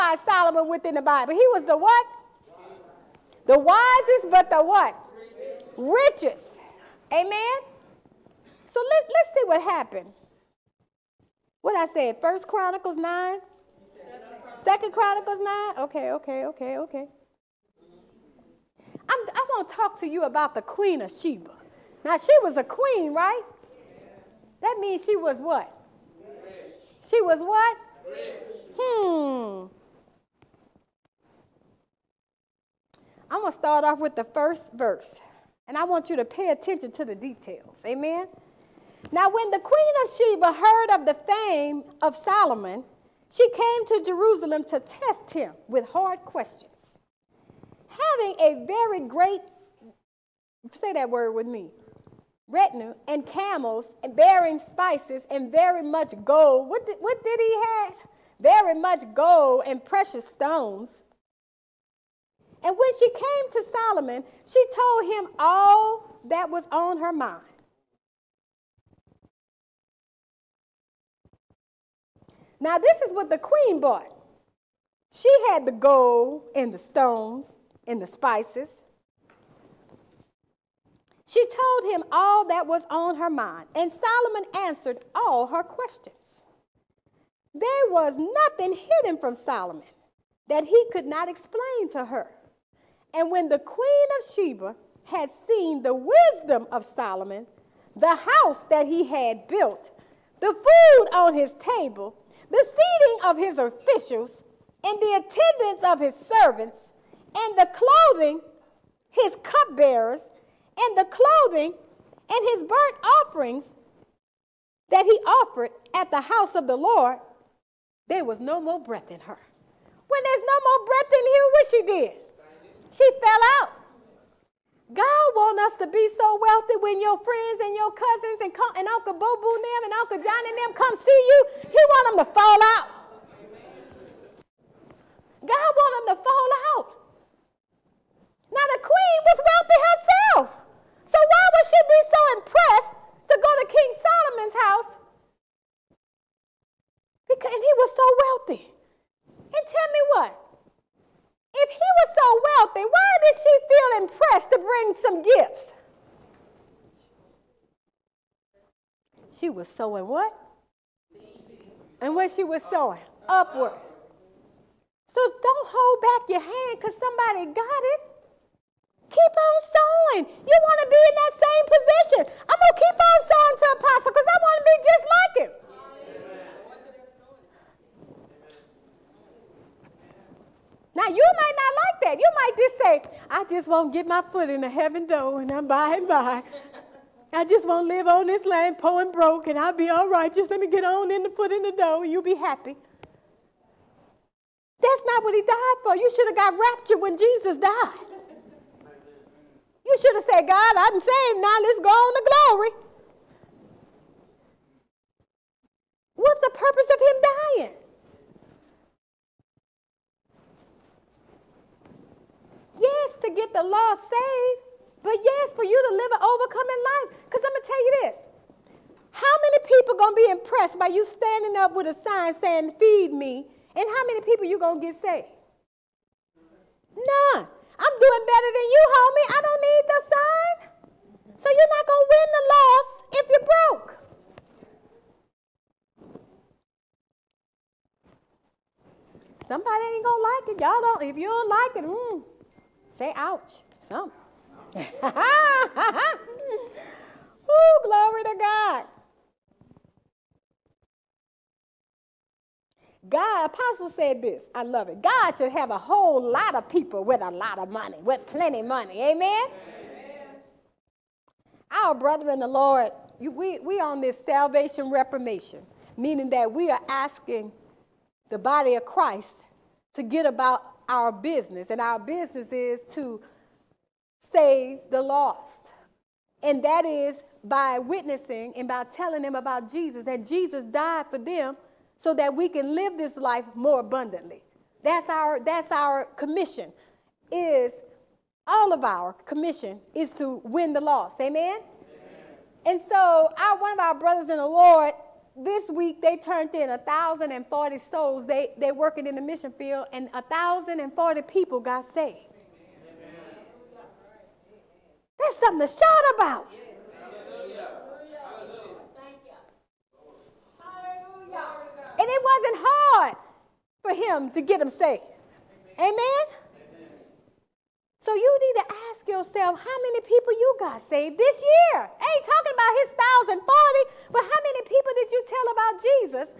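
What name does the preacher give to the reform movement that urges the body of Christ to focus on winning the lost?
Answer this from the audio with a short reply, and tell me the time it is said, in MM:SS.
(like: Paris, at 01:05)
salvation reformation, at 04:24.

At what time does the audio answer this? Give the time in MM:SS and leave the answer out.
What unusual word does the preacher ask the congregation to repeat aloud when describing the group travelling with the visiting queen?
00:52.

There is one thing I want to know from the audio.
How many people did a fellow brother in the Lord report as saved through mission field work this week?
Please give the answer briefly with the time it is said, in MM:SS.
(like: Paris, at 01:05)
1,040, at 04:56.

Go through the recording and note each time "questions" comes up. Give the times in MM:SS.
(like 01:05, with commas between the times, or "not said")
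00:46, 01:25.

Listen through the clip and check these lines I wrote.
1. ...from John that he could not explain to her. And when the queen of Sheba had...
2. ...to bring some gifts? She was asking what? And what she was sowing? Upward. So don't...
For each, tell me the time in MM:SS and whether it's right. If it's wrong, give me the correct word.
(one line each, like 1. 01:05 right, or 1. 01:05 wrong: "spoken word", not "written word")
1. 01:29 wrong: "Solomon", not "John"
2. 02:34 wrong: "sowing", not "asking".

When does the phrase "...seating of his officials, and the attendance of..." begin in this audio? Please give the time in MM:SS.
01:42.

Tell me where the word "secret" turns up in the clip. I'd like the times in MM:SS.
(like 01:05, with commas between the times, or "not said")
not said.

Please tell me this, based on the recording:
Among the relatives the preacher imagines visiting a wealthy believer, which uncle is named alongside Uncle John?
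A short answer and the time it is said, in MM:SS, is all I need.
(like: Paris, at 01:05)
Uncle Boo Boo, at 02:08.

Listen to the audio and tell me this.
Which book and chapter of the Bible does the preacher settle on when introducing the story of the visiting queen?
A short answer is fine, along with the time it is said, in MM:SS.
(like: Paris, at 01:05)
Second Chronicles 9, at 00:14.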